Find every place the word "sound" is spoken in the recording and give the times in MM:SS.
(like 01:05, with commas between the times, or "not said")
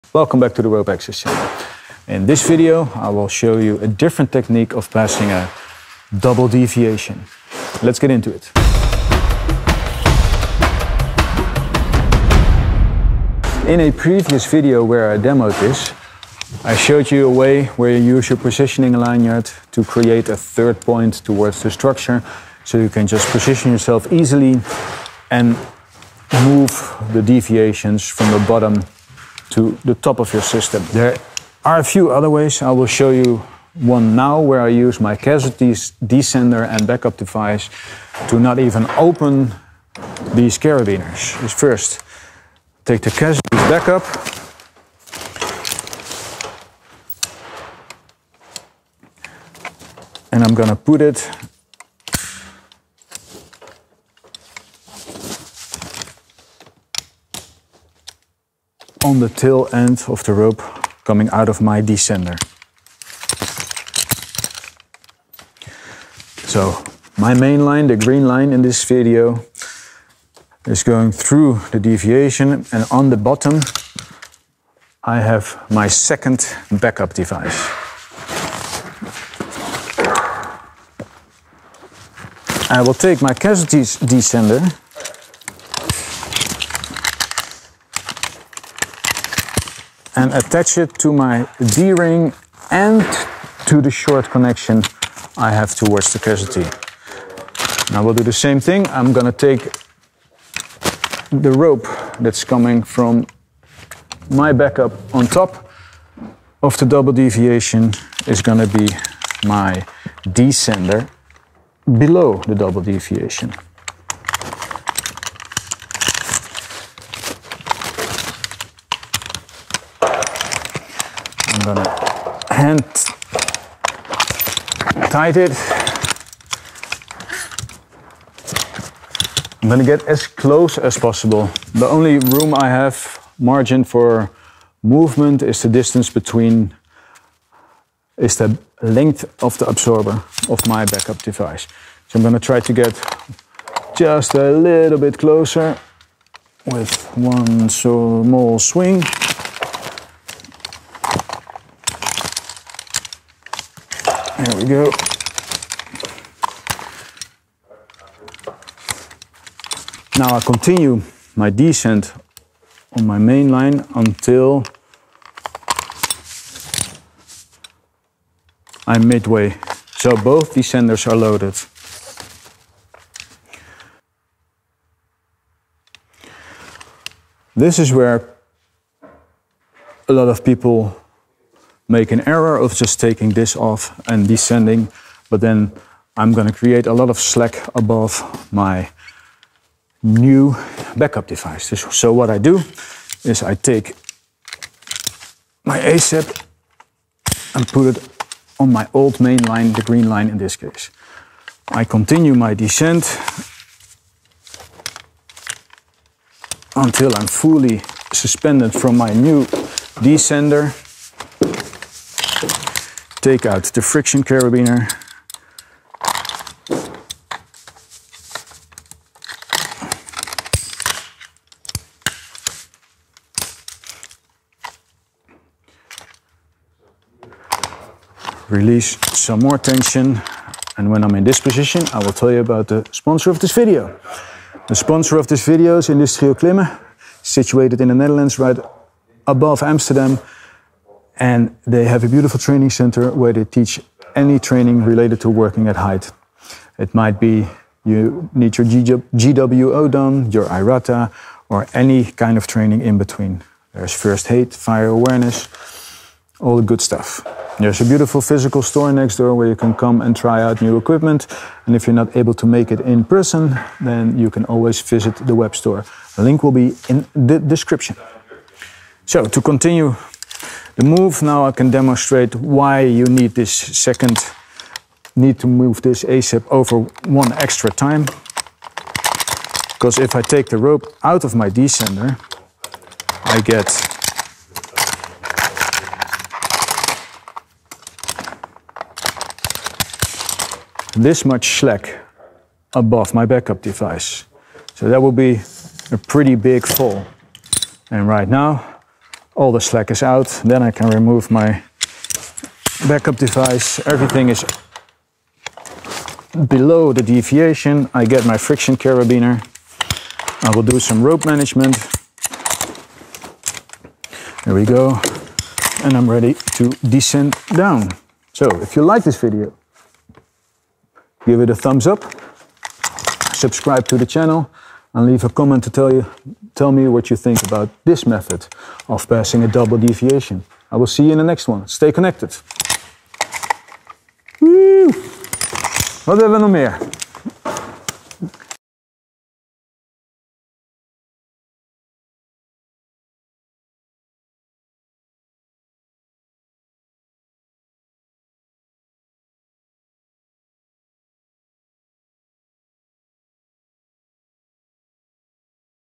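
not said.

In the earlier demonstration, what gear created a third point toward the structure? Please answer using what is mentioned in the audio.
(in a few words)
Positioning lanyard.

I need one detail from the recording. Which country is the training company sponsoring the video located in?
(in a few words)
The Netherlands.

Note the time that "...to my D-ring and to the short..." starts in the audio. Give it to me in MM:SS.
01:30.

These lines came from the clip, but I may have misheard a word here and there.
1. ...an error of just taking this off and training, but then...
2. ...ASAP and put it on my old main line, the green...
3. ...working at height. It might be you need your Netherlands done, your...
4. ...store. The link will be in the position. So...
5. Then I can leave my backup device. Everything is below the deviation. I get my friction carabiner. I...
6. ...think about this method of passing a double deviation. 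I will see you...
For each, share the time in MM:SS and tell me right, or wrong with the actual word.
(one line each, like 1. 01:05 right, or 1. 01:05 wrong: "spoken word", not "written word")
1. 03:02 wrong: "descending", not "training"
2. 03:15 right
3. 04:05 wrong: "GWO", not "Netherlands"
4. 04:25 wrong: "description", not "position"
5. 05:00 wrong: "remove", not "leave"
6. 05:27 right.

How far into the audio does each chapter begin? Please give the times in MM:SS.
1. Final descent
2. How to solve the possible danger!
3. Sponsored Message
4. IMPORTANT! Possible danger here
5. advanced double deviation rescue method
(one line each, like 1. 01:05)
1. 05:12
2. 04:28
3. 03:52
4. 02:55
5. 00:15.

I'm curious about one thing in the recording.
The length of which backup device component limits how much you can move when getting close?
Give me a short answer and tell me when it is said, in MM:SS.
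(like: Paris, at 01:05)
The absorber, at 02:19.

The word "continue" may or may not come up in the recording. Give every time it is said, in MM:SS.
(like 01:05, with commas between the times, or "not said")
02:40, 03:21, 04:29.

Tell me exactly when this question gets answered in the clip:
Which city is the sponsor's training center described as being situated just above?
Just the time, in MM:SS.
03:59.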